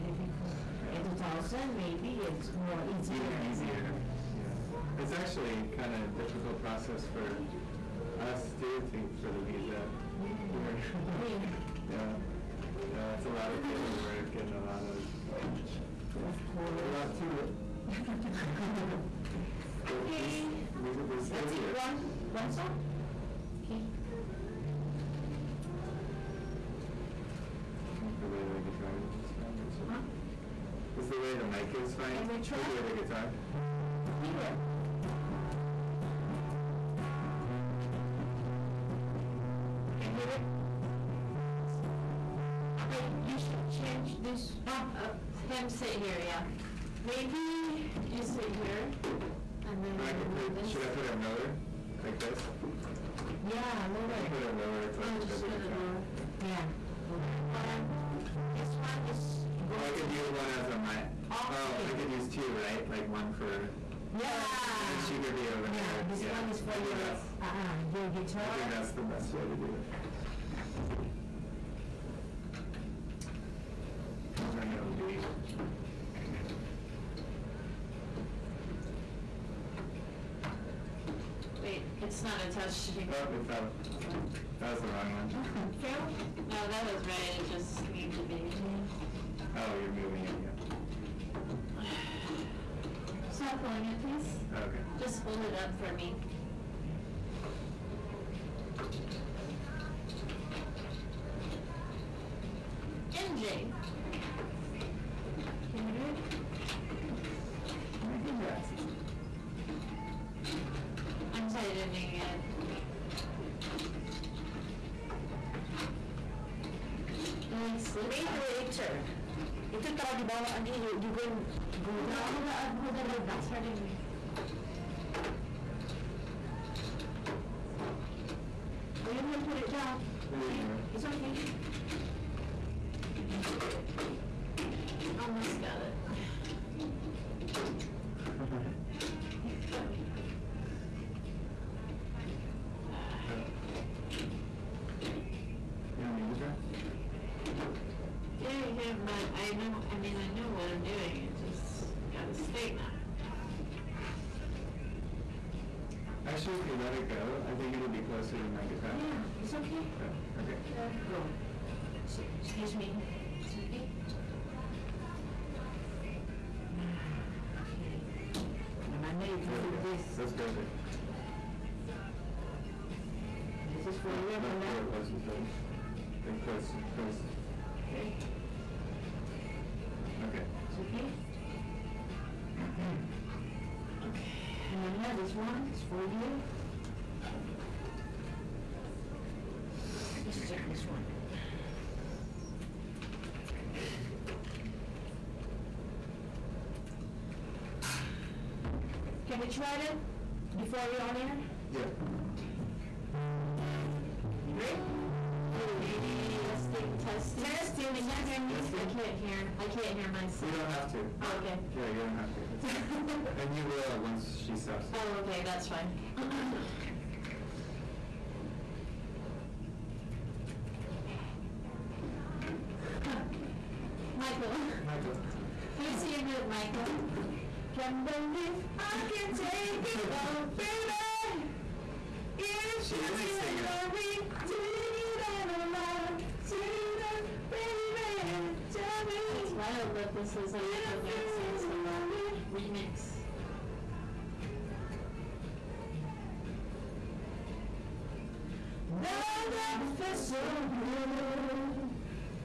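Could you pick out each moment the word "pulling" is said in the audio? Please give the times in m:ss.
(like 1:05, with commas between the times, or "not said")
1:33.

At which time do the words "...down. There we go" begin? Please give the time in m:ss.
2:09.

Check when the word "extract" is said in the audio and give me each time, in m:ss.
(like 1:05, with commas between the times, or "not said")
not said.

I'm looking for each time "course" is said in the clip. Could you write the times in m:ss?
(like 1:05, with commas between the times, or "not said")
0:16.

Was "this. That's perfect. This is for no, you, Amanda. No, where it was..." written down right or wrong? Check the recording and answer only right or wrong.
right.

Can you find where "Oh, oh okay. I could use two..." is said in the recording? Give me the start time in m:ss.
1:01.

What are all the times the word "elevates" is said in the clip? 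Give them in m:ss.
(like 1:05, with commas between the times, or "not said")
not said.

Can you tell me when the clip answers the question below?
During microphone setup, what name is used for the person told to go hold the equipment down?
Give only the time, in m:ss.
2:00.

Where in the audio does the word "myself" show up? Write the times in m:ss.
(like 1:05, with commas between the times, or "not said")
3:30.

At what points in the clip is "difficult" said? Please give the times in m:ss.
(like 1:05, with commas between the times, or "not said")
0:00, 0:06.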